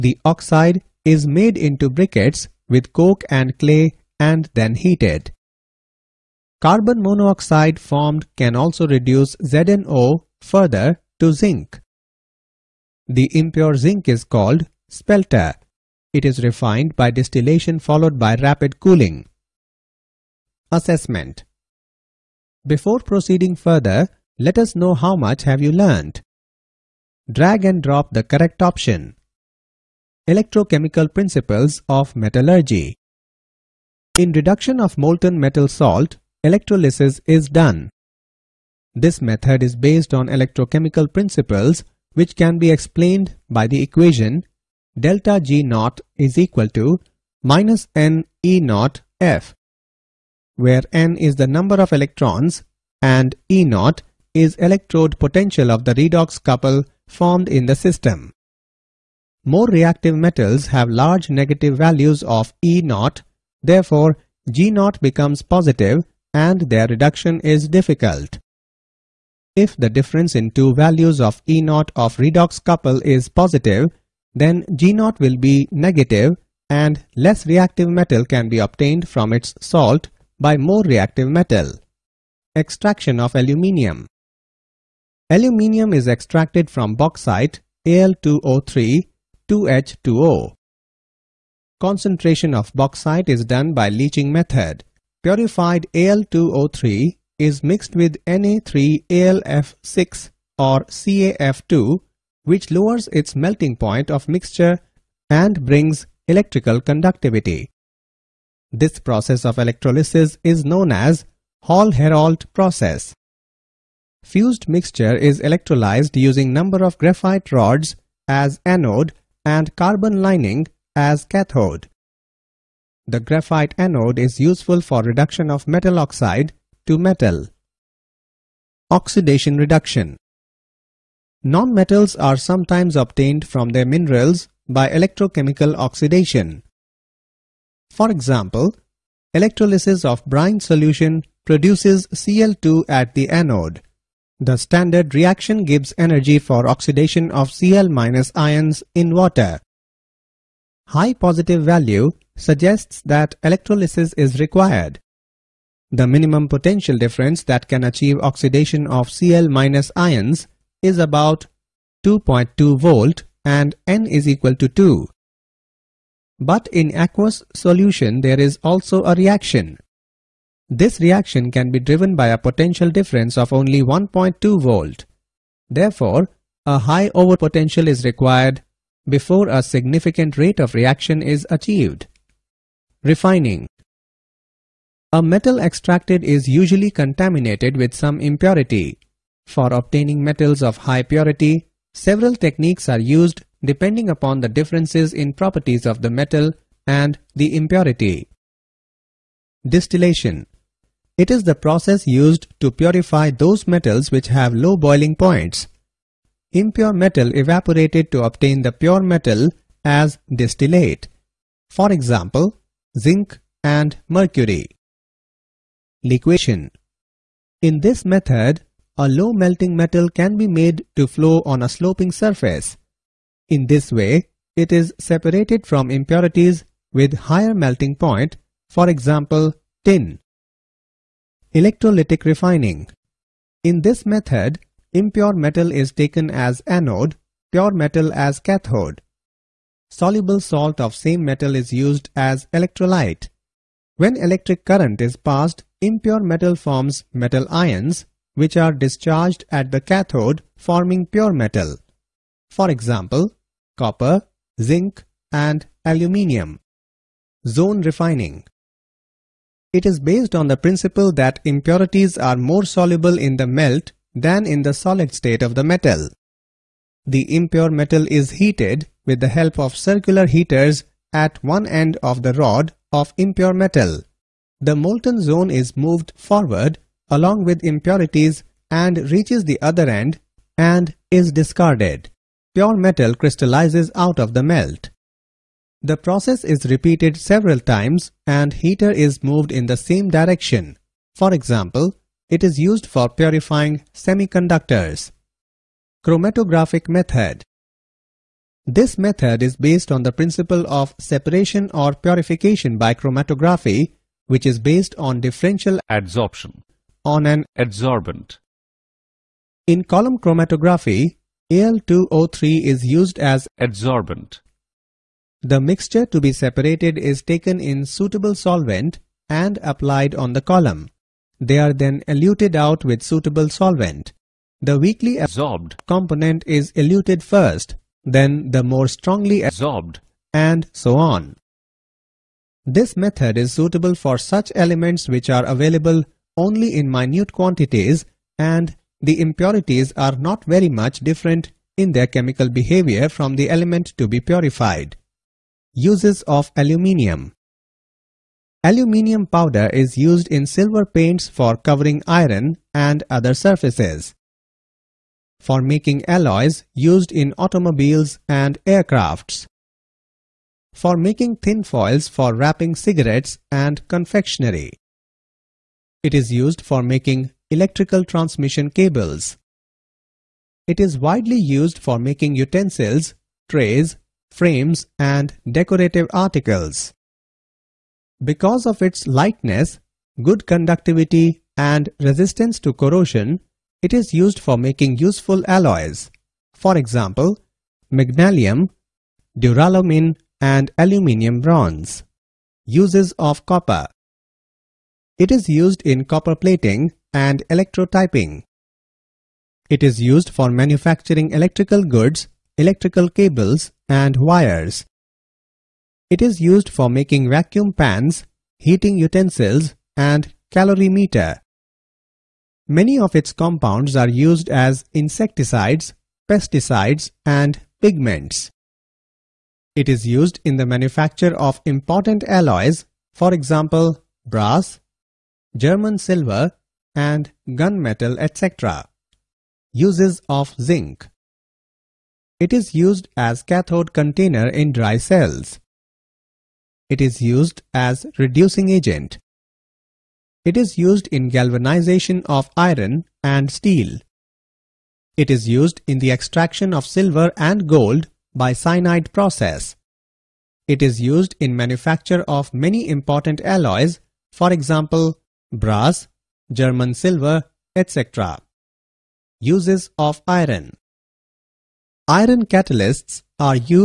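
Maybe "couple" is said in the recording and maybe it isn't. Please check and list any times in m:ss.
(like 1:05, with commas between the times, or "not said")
0:56, 1:12.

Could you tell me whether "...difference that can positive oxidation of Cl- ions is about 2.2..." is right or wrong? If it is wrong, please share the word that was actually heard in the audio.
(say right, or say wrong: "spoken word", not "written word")
wrong: "achieve", not "positive".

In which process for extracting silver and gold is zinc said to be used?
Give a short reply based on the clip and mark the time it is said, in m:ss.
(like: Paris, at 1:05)
Cyanide process, at 7:28.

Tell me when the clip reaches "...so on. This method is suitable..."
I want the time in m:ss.
5:30.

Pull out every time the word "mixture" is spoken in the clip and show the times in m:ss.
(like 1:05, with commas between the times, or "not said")
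1:44, 1:54, 5:15.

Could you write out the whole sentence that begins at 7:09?
Uses of zinc It is used as cathode container in dry cells.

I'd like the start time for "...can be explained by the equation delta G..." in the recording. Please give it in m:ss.
0:42.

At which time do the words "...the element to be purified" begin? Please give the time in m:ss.
5:43.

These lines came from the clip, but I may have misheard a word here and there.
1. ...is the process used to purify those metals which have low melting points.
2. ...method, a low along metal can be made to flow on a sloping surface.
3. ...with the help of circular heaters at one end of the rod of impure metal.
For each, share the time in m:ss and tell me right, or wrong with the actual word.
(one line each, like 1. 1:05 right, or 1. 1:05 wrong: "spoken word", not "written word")
1. 3:21 wrong: "boiling", not "melting"
2. 3:38 wrong: "melting", not "along"
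3. 4:29 right.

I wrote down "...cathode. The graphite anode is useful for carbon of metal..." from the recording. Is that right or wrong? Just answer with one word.
wrong.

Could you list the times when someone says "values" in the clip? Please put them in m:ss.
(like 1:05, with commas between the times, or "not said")
1:01, 1:10, 2:31.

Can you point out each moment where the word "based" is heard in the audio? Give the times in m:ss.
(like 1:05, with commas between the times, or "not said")
0:39, 4:19, 4:59, 5:04.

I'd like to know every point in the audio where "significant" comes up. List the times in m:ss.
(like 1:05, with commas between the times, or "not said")
2:59.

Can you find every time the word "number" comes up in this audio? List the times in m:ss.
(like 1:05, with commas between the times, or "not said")
0:51, 1:56.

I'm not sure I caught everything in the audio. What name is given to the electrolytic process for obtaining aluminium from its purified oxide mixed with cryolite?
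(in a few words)
Hall-Heroult process.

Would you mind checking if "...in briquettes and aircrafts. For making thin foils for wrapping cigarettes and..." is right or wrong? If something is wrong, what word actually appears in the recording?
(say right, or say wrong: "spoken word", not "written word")
wrong: "automobiles", not "briquettes".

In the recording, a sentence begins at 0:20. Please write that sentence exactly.
Assessment before proceeding further, let us know how much have you learnt.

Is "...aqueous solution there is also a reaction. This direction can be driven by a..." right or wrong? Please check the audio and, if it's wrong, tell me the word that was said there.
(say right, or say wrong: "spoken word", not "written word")
wrong: "reaction", not "direction".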